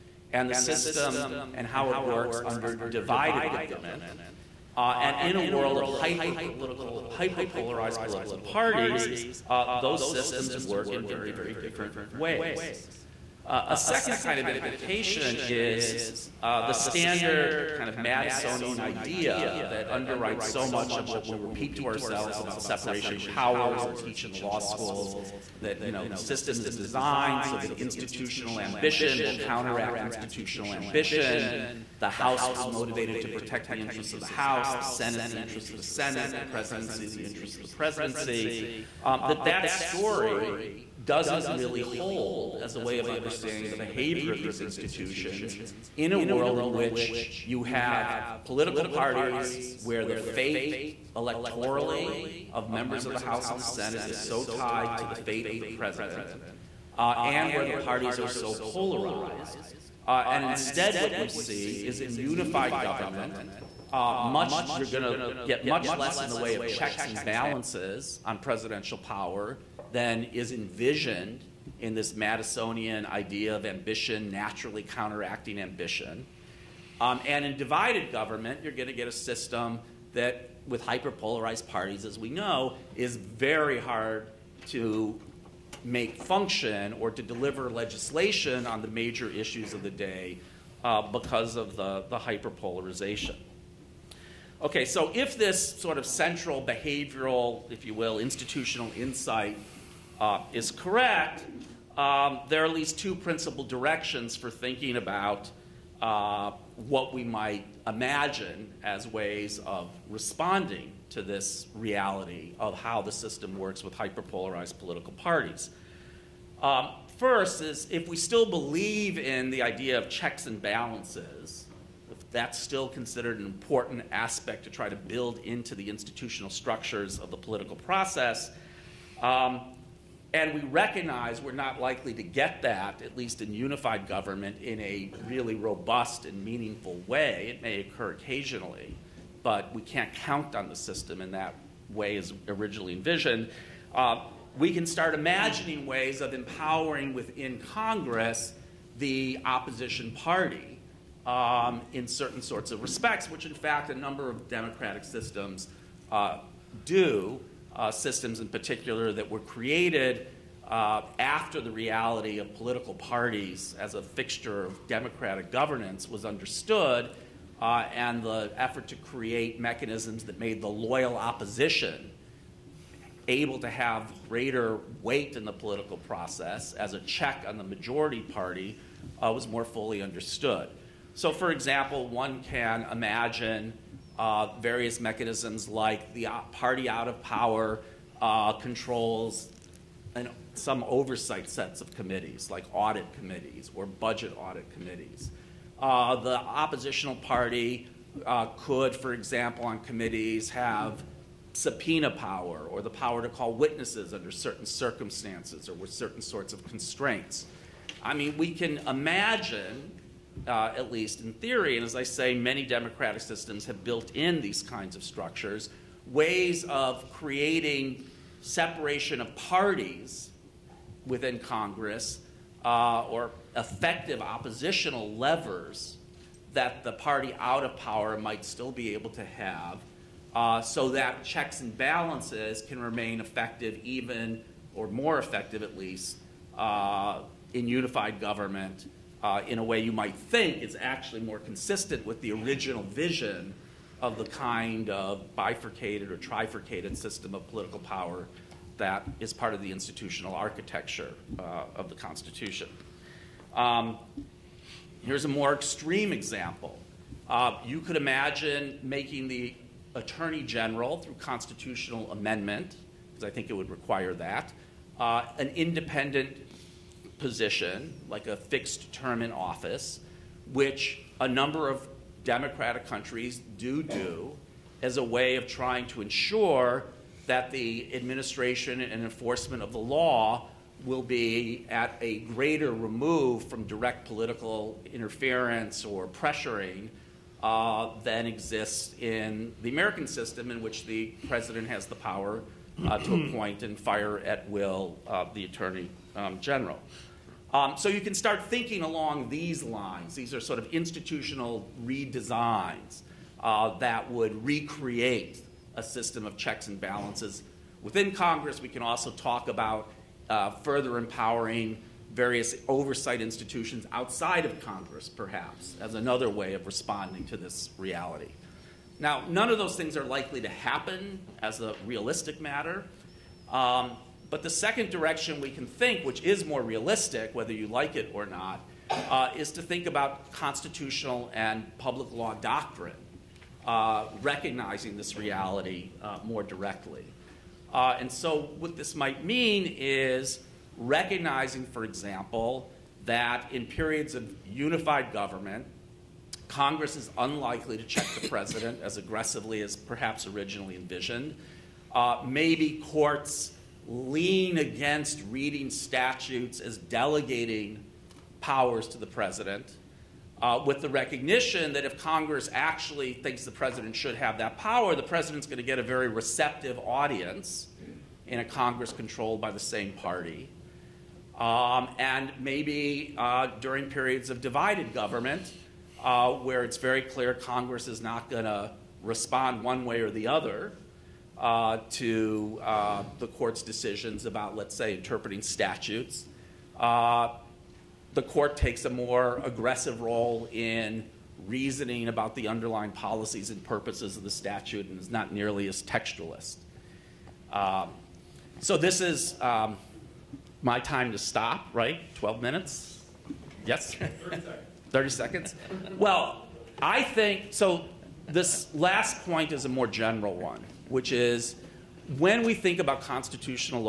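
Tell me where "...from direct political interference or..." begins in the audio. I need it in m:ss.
4:43.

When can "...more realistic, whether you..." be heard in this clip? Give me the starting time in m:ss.
5:26.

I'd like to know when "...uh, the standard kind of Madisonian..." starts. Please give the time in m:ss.
0:16.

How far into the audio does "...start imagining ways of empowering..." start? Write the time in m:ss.
2:24.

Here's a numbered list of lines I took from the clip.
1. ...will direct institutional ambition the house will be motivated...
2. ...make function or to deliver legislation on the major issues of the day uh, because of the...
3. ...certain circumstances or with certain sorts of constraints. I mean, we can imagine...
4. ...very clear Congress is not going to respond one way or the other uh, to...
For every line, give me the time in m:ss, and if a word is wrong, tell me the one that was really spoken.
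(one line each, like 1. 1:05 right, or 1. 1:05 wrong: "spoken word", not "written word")
1. 0:29 wrong: "counteract", not "direct"
2. 1:25 right
3. 3:24 right
4. 6:16 right.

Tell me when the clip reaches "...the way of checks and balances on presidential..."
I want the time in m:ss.
1:06.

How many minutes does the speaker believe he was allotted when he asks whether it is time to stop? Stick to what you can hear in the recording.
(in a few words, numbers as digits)
12.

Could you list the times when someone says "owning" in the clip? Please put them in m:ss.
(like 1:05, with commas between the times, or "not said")
not said.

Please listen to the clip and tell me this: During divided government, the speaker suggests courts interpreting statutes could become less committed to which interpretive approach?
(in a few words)
textualist.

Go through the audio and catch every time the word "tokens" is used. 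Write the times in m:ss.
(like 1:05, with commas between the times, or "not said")
not said.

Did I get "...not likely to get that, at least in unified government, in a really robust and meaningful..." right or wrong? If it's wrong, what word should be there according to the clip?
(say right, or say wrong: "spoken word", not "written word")
right.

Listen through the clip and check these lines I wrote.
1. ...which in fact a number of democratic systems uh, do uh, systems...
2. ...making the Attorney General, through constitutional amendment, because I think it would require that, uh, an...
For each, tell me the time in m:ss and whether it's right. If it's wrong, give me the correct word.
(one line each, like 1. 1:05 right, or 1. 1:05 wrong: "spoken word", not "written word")
1. 2:33 right
2. 4:18 right.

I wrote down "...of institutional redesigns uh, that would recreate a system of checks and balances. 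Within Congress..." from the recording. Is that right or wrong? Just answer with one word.
right.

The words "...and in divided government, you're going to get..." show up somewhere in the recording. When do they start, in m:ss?
1:17.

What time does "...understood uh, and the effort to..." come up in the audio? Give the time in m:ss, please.
2:46.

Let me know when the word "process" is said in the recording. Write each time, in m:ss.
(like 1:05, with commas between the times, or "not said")
2:07, 2:55.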